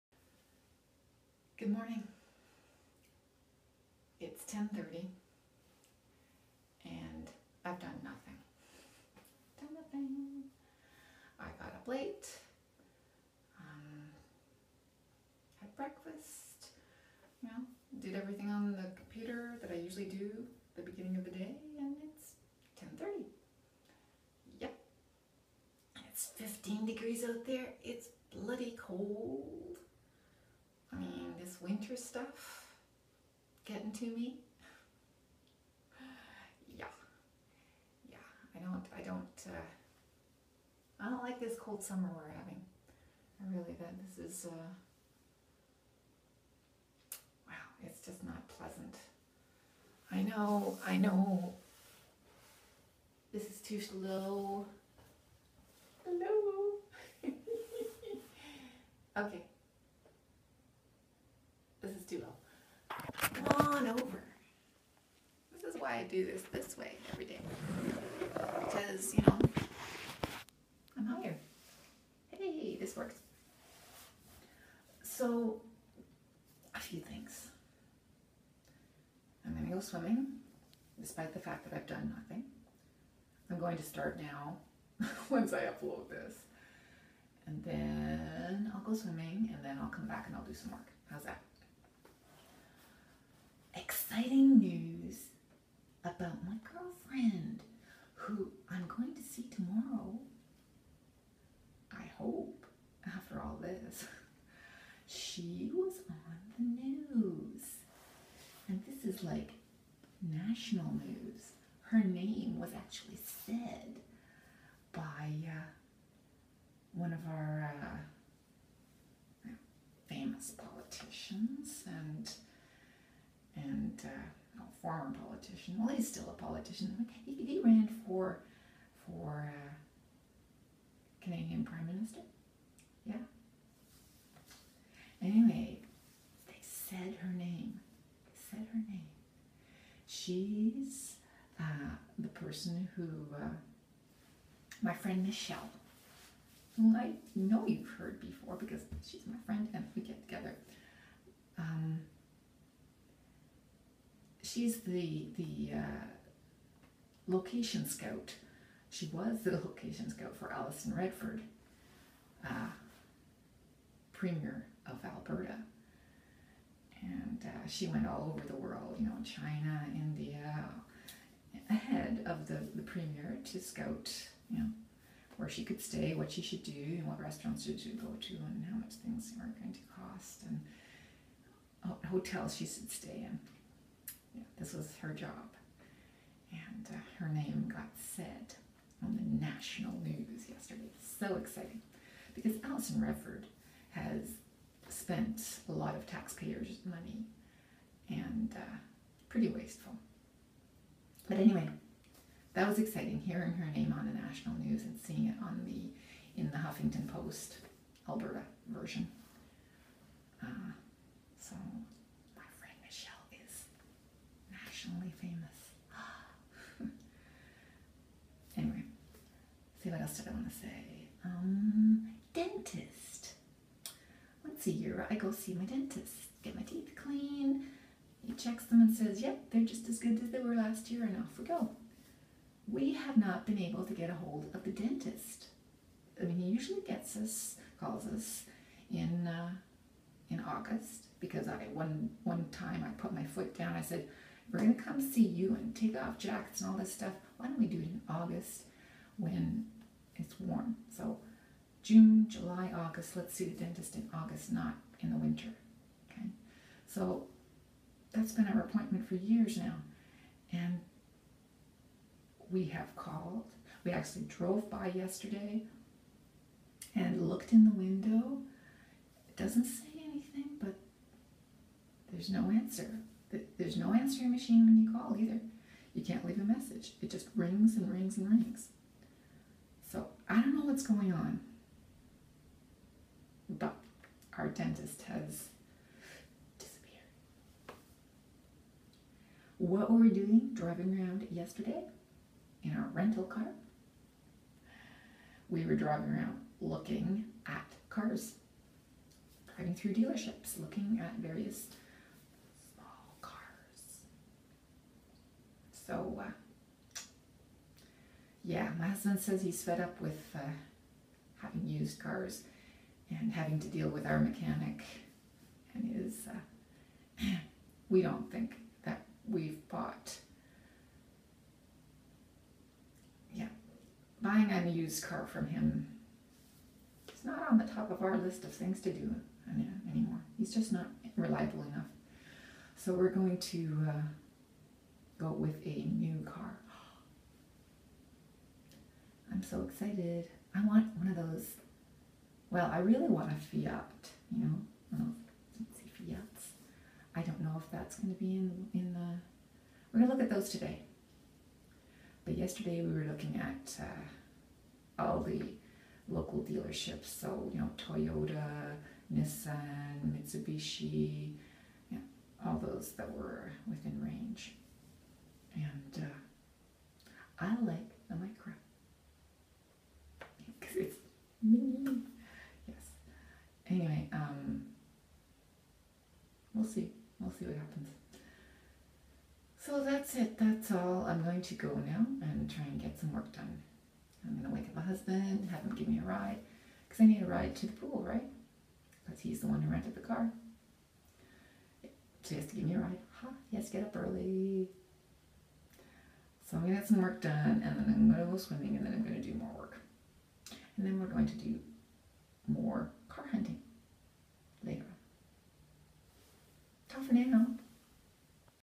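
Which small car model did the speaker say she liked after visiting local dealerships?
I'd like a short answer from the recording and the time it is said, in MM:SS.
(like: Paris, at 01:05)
Micra, at 06:08.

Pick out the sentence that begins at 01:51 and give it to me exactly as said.
Her name was actually said by uh, one of our uh, famous politicians and and uh, former politician.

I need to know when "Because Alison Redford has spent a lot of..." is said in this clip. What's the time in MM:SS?
03:12.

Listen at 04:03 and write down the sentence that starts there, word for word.
I said, "We're gonna come see you and take off jackets and all this stuff.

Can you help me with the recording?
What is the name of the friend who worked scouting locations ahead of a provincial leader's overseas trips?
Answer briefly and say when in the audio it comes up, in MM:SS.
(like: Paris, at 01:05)
Michelle, at 02:25.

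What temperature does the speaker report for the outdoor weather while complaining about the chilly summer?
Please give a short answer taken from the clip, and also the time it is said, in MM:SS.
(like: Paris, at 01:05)
15 degrees, at 00:26.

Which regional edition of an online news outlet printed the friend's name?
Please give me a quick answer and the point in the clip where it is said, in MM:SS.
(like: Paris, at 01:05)
Huffington Post Alberta, at 03:26.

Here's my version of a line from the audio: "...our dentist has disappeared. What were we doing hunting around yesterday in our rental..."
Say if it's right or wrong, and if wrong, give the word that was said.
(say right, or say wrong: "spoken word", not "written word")
wrong: "driving", not "hunting".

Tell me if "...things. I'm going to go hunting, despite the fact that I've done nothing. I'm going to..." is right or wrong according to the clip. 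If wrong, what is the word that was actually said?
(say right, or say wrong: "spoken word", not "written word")
wrong: "swimming", not "hunting".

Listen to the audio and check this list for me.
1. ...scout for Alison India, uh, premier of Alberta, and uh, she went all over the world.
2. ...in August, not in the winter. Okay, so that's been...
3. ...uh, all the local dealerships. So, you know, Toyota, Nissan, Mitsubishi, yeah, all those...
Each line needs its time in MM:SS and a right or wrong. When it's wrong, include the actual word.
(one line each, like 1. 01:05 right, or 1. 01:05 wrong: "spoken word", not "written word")
1. 02:40 wrong: "Redford", not "India"
2. 04:13 right
3. 05:53 right.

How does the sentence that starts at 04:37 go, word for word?
It just rings and rings and rings.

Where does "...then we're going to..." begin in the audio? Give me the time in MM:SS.
06:40.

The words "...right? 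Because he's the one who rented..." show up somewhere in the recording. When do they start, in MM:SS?
06:28.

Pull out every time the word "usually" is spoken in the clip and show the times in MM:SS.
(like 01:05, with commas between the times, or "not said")
00:19, 03:56.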